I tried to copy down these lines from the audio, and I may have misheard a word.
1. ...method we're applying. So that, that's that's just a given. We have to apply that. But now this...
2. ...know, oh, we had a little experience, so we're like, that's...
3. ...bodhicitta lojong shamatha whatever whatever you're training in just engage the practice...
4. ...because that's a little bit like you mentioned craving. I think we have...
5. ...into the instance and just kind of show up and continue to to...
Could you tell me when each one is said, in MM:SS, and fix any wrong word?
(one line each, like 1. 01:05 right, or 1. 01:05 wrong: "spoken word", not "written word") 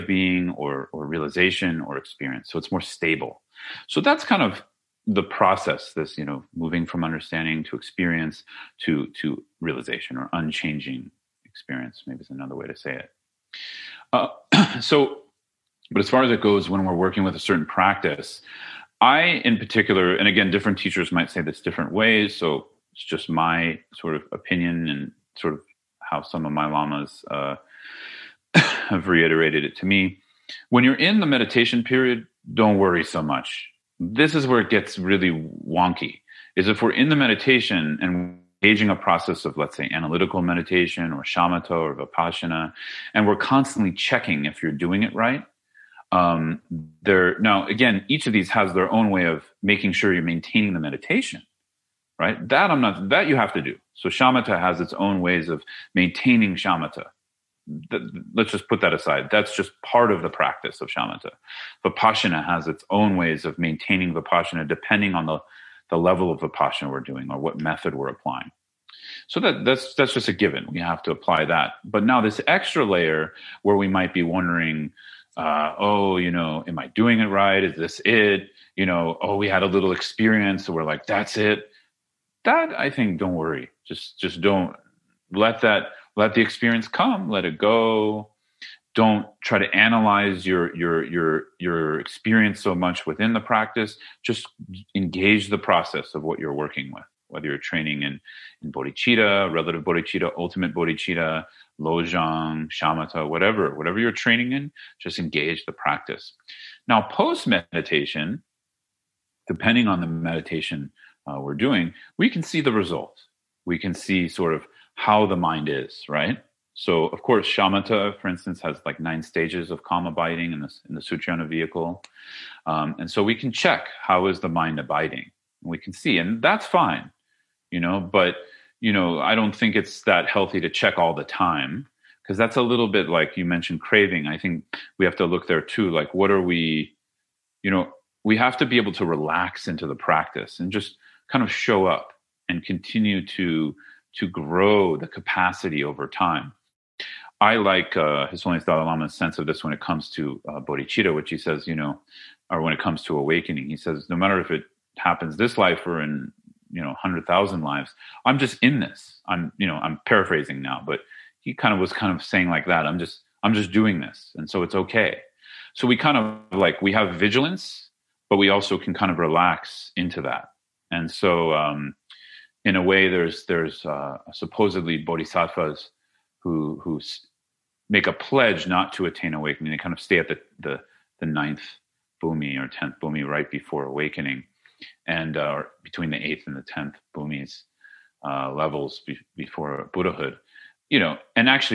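1. 01:07 right
2. 01:18 right
3. 01:40 right
4. 02:12 right
5. 02:19 wrong: "practice", not "instance".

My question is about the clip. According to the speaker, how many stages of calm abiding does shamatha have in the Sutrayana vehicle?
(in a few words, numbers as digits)
9.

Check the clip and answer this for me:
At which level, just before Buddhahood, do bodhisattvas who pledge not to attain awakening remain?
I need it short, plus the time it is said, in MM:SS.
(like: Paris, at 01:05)
Ninth bhumi, at 03:01.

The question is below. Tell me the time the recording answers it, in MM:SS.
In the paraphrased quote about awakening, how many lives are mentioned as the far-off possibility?
02:37.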